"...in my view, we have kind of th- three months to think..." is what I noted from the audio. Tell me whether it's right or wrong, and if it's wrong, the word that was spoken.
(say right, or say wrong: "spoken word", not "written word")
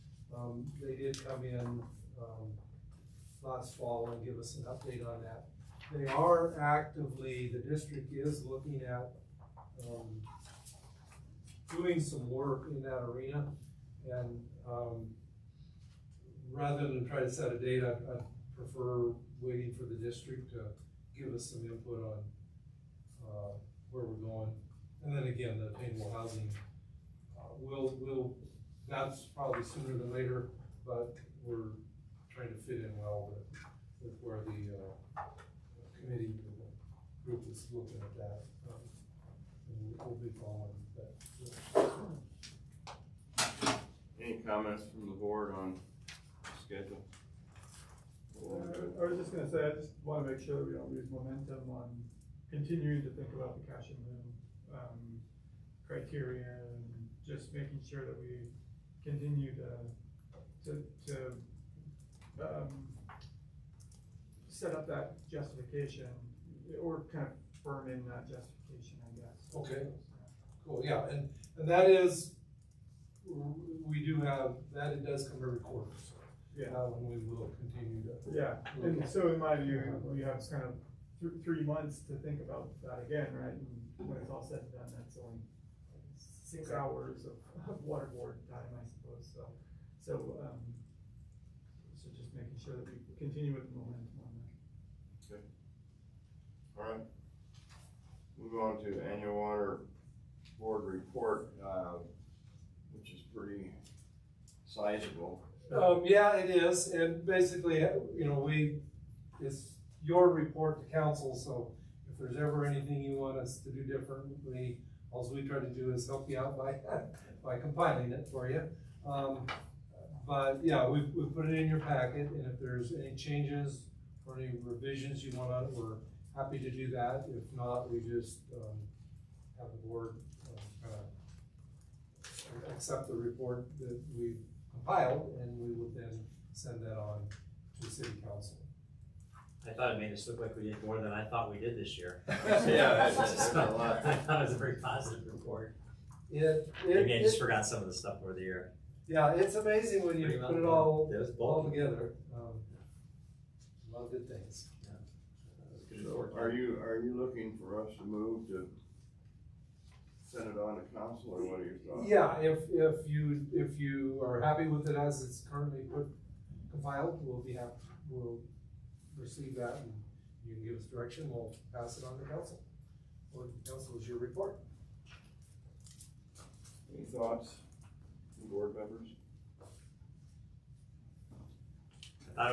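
right.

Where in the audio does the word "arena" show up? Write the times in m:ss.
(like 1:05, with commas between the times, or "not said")
0:13.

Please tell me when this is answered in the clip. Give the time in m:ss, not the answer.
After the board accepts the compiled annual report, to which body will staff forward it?
2:17.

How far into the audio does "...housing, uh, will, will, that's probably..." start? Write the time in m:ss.
0:26.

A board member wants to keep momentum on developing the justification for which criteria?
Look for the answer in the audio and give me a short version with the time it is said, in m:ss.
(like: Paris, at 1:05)
cash in lieu, at 0:53.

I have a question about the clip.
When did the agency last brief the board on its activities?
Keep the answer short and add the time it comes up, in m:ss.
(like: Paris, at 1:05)
last fall, at 0:03.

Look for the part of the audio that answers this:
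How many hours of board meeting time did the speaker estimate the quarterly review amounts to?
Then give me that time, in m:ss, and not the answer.
1:26.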